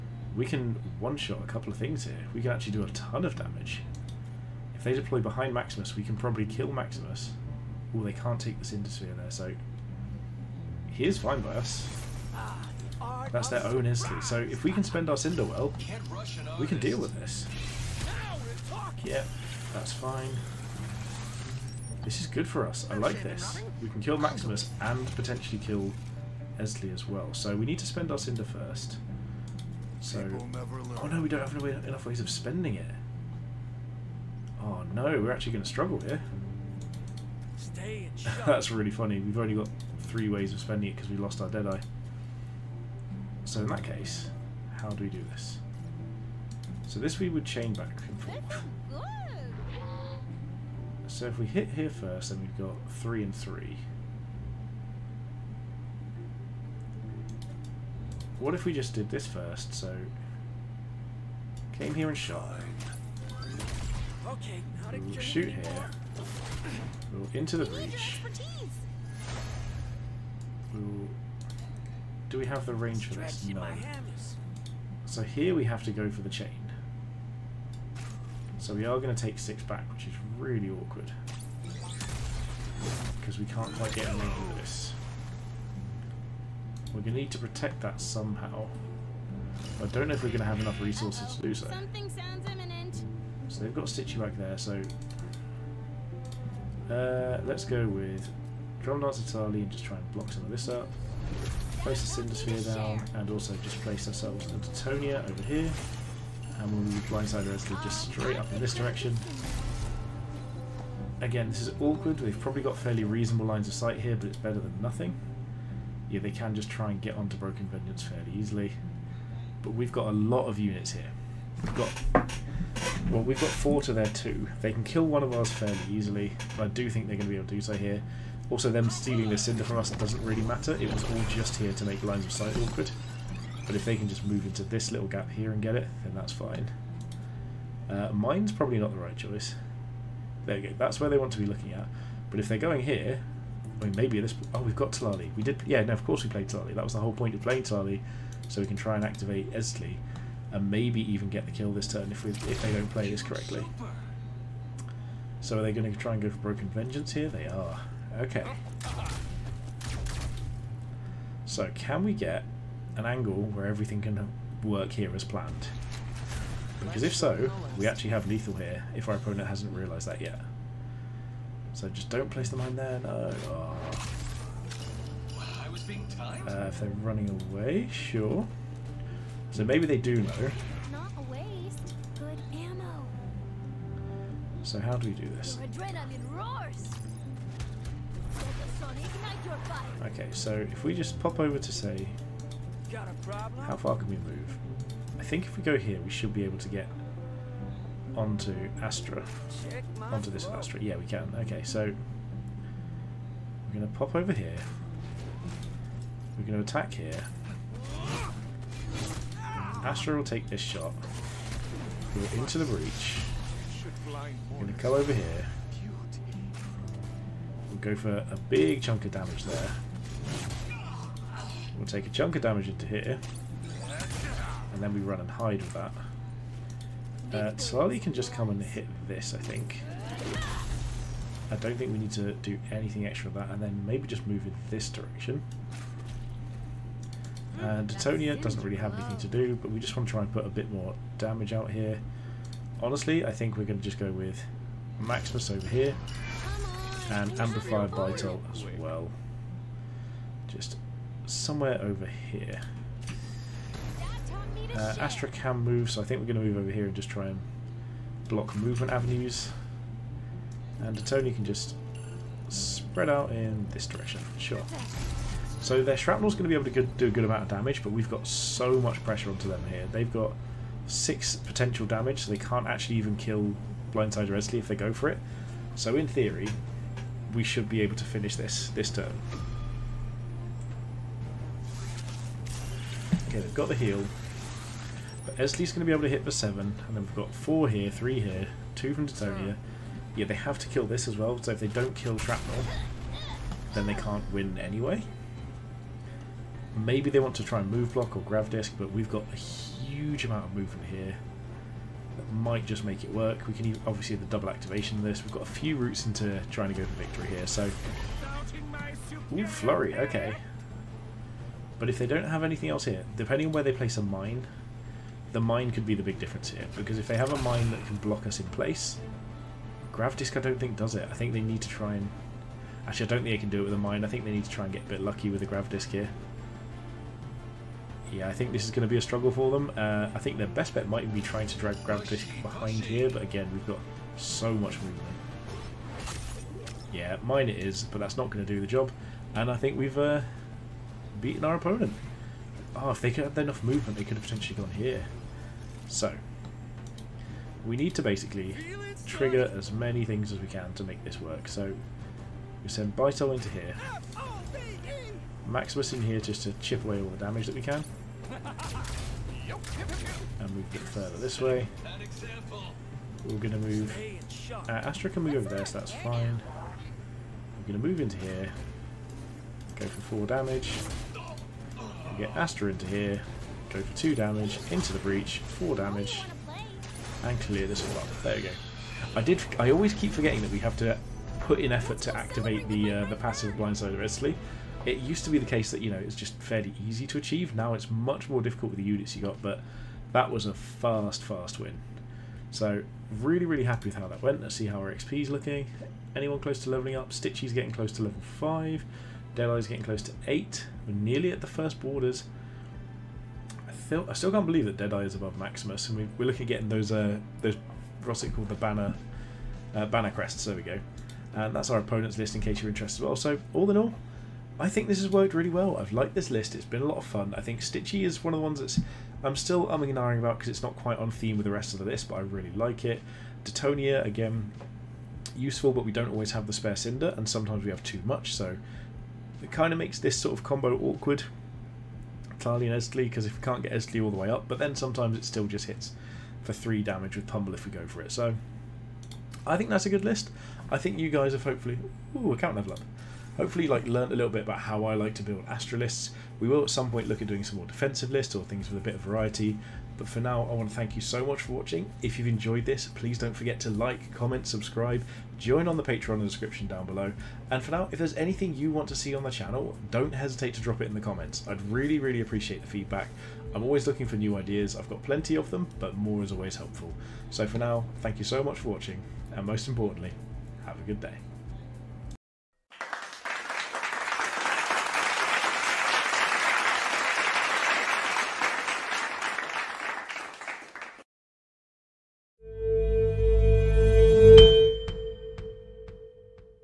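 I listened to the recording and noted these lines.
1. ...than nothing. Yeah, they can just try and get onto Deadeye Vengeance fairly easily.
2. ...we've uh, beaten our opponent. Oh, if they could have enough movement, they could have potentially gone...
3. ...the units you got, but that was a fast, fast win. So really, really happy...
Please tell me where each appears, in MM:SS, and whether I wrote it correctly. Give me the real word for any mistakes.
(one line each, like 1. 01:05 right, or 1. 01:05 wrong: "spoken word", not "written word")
1. 01:54 wrong: "Broken", not "Deadeye"
2. 05:39 right
3. 06:28 right.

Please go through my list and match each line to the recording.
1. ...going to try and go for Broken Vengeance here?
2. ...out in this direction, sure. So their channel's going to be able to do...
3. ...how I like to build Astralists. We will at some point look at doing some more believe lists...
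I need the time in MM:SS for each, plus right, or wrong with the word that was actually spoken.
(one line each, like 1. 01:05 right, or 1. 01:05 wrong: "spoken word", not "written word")
1. 02:35 right
2. 04:23 wrong: "shrapnel", not "channel"
3. 07:24 wrong: "defensive", not "believe".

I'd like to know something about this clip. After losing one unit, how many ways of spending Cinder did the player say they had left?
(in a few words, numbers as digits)
3.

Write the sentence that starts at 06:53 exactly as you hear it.
So all in all, I think this has worked really well.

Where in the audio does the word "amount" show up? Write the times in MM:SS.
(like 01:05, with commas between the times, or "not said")
04:27, 05:00.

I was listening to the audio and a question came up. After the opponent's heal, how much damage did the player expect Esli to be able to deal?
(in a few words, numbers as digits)
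7.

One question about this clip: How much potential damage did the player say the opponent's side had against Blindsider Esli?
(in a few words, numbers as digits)
6.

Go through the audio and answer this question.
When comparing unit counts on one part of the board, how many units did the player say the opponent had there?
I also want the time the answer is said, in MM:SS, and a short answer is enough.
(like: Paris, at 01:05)
2, at 02:03.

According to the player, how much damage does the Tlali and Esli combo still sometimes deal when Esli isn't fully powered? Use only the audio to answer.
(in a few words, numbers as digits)
3.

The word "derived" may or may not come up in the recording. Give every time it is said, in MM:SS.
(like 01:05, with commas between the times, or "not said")
not said.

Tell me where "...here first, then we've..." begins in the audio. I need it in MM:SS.
00:51.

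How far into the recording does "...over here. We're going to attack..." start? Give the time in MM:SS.
03:24.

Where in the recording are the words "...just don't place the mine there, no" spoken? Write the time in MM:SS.
02:51.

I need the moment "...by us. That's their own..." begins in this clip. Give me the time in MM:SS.
00:11.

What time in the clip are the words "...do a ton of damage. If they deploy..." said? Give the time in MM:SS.
00:02.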